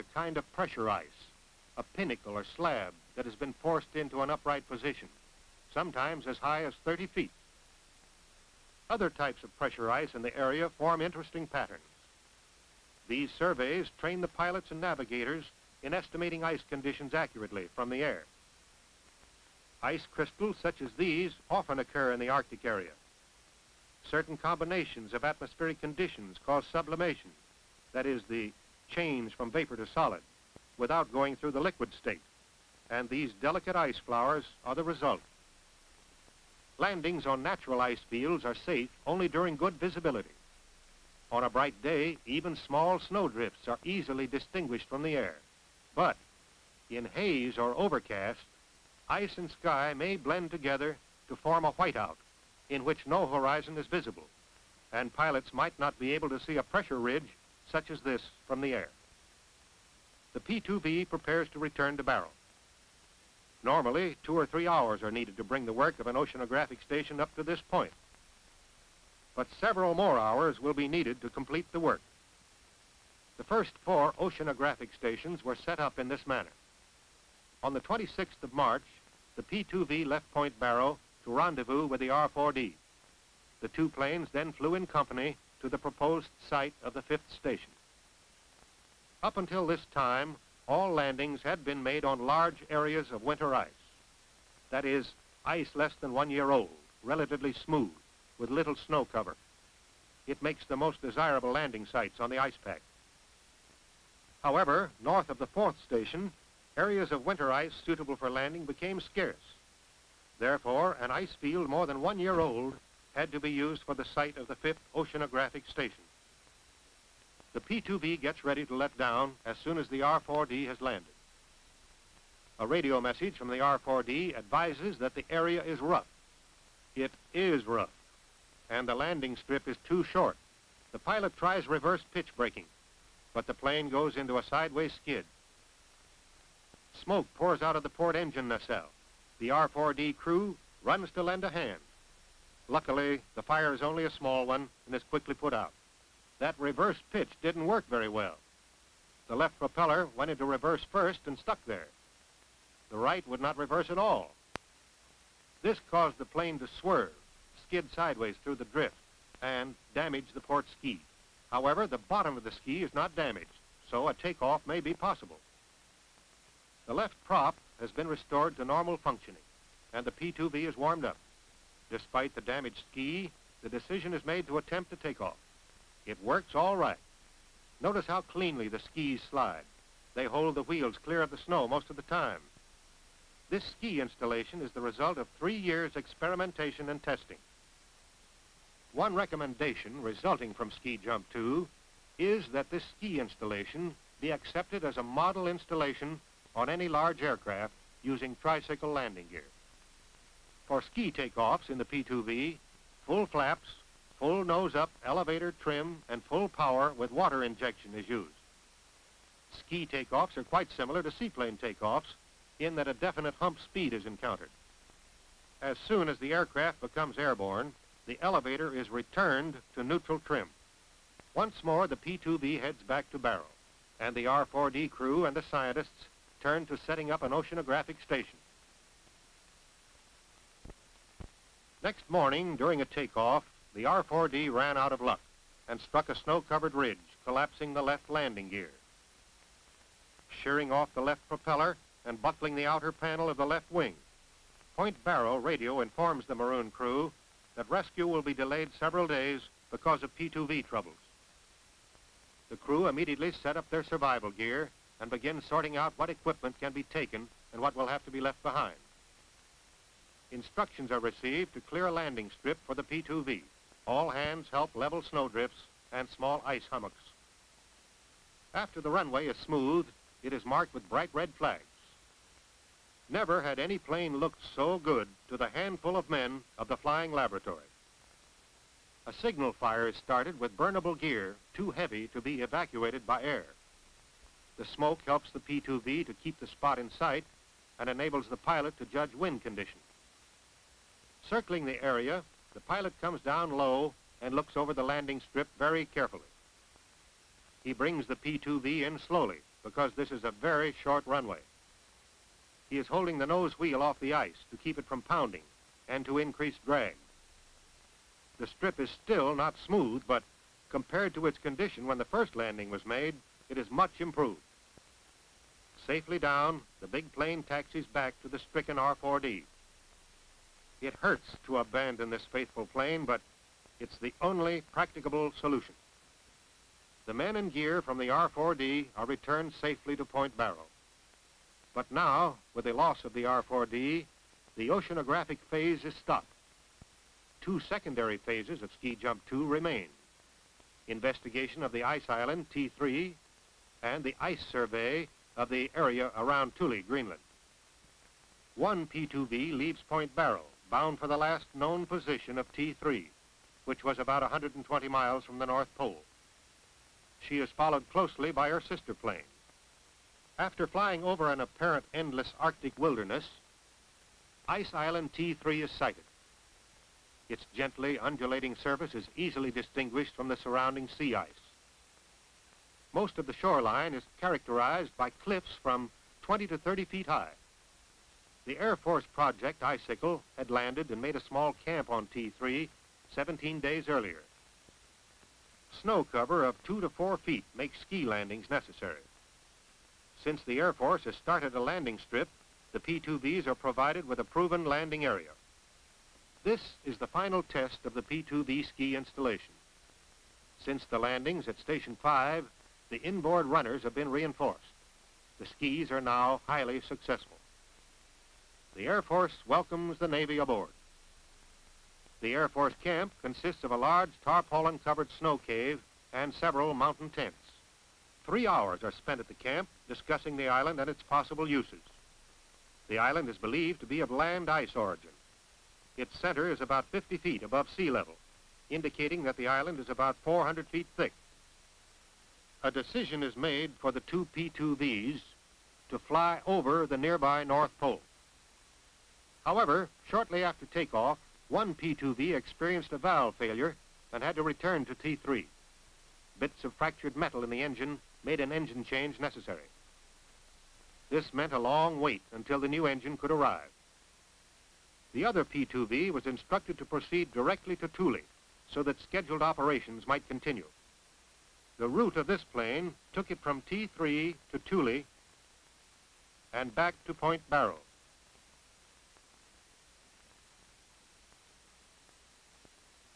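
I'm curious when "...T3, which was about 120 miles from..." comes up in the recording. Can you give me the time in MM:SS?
05:52.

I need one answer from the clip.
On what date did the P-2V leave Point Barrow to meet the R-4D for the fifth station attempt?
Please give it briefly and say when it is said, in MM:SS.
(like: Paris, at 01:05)
March 26, at 01:17.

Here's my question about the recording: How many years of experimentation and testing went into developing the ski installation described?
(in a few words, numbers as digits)
3.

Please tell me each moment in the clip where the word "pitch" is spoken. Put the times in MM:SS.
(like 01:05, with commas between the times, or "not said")
02:12, 02:27.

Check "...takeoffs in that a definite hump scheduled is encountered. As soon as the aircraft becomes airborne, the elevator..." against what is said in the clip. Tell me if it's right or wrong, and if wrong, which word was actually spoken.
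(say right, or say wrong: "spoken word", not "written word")
wrong: "speed", not "scheduled".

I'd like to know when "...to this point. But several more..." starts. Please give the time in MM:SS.
01:07.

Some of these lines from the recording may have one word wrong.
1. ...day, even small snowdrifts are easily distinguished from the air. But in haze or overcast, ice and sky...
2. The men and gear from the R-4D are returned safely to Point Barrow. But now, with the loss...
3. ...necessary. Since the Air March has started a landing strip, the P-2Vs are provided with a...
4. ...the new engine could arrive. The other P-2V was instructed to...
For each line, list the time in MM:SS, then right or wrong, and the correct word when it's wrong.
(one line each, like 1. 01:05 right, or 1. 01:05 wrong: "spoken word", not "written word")
1. 00:41 right
2. 05:27 right
3. 06:28 wrong: "Force", not "March"
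4. 07:32 right.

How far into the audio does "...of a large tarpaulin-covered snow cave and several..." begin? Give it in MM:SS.
06:53.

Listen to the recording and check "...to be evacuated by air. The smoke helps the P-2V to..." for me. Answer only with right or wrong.
right.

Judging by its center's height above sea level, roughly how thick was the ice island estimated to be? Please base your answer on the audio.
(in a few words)
400 feet.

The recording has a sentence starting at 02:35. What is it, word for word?
This caused the plane to swerve, skid sideways through the drift, and damage the port ski.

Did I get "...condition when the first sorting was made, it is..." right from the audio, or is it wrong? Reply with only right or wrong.
wrong.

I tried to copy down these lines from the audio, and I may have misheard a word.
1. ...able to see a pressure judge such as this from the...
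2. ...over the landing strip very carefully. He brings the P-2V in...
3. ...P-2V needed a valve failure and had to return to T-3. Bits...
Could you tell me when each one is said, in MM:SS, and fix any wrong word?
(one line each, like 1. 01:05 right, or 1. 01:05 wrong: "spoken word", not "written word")
1. 00:56 wrong: "ridge", not "judge"
2. 04:54 right
3. 07:21 wrong: "experienced", not "needed".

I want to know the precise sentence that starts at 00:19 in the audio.
Ice crystals such as these often occur in the Arctic area.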